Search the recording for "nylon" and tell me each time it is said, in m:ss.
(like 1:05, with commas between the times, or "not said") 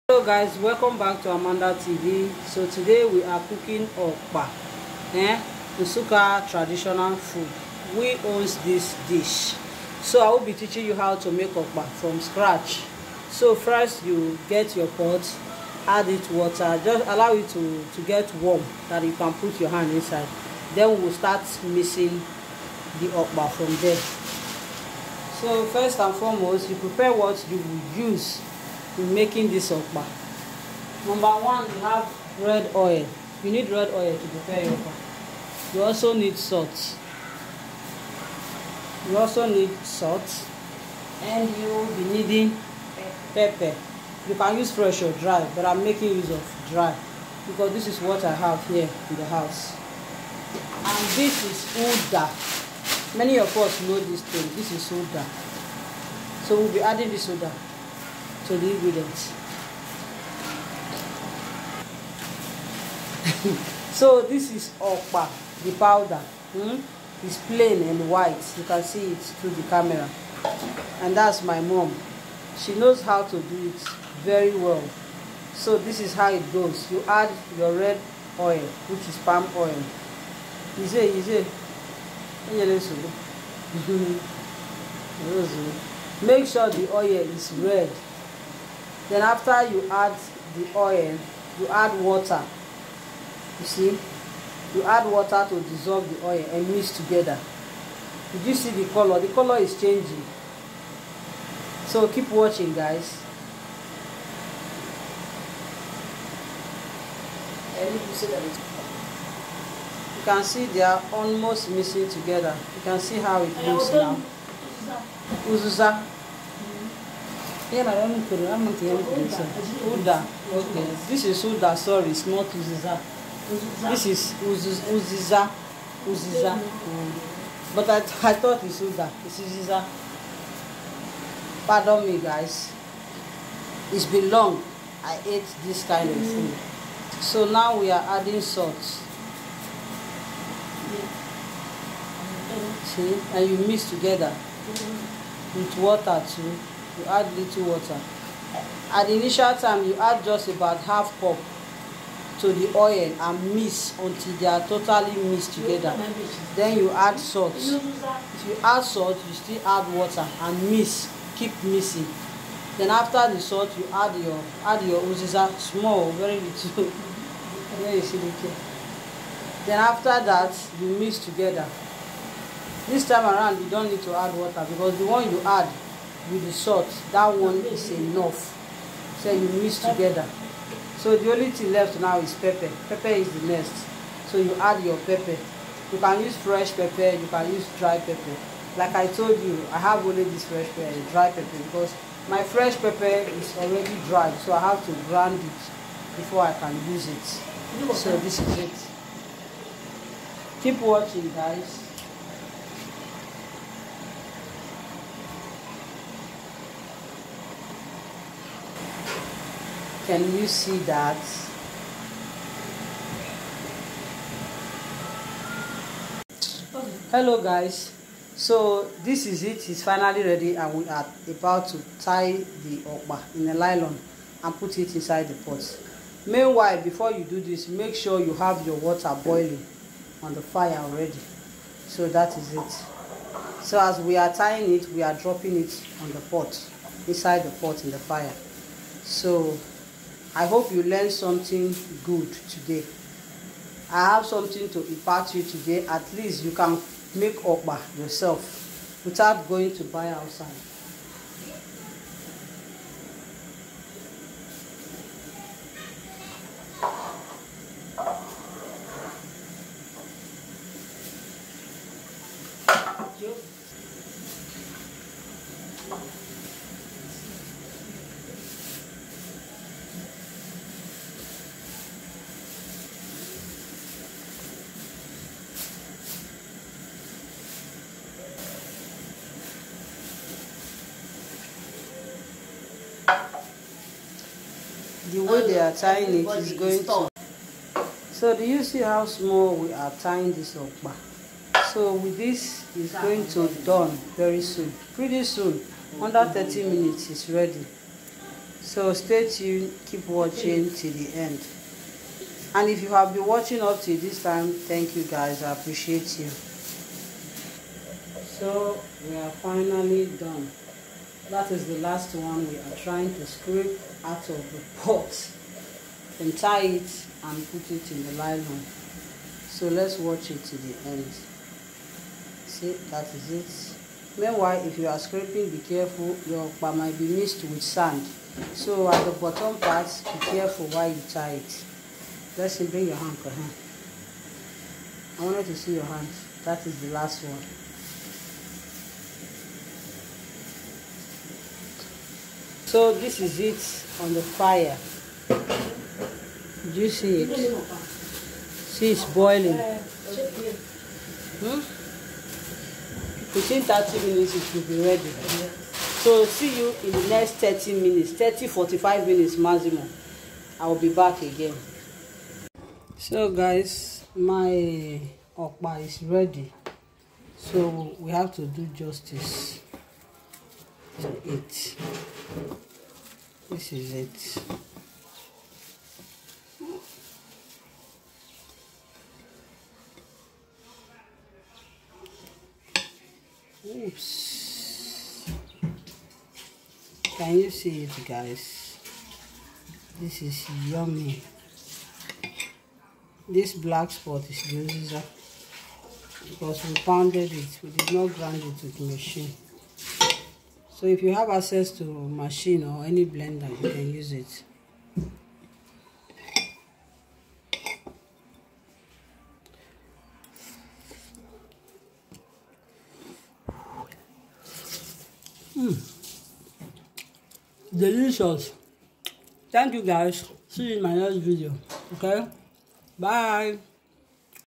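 3:43, 5:18.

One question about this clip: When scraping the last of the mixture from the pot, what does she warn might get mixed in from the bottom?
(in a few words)
Sand.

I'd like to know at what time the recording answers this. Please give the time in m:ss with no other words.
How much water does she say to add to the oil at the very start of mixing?
2:30.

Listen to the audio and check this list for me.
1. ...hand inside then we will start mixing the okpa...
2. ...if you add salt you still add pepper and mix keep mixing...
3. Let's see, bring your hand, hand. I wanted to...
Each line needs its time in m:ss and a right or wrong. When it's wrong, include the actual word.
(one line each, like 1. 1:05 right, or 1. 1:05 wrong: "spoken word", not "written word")
1. 0:19 right
2. 2:37 wrong: "water", not "pepper"
3. 5:32 right.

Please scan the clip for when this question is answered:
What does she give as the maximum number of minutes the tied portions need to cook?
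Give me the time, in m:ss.
5:58.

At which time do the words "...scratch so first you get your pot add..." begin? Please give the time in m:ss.
0:12.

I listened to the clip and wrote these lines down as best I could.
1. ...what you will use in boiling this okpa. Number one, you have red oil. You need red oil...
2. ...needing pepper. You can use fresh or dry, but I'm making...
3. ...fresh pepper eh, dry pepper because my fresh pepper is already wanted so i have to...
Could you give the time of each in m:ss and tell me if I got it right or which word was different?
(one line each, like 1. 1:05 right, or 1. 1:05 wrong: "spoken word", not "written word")
1. 0:27 wrong: "making", not "boiling"
2. 0:42 right
3. 3:10 wrong: "dried", not "wanted".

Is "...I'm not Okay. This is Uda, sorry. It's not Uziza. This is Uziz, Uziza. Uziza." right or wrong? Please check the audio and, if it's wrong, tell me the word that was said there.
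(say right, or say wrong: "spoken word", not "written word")
right.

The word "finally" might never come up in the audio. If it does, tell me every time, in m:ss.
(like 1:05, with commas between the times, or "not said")
3:39, 5:09.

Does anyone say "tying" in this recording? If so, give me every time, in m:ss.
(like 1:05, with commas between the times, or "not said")
3:54, 4:45, 4:49.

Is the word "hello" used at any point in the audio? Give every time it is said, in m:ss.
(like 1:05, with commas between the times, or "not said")
0:00, 3:37.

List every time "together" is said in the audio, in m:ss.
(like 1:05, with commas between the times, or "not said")
1:36, 1:52, 2:23, 2:35, 2:51, 2:59.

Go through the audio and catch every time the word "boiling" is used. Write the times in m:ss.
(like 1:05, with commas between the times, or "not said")
3:49, 5:49.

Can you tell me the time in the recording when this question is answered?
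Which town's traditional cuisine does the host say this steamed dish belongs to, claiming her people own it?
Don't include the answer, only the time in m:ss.
0:05.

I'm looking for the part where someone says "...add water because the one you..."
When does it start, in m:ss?
2:54.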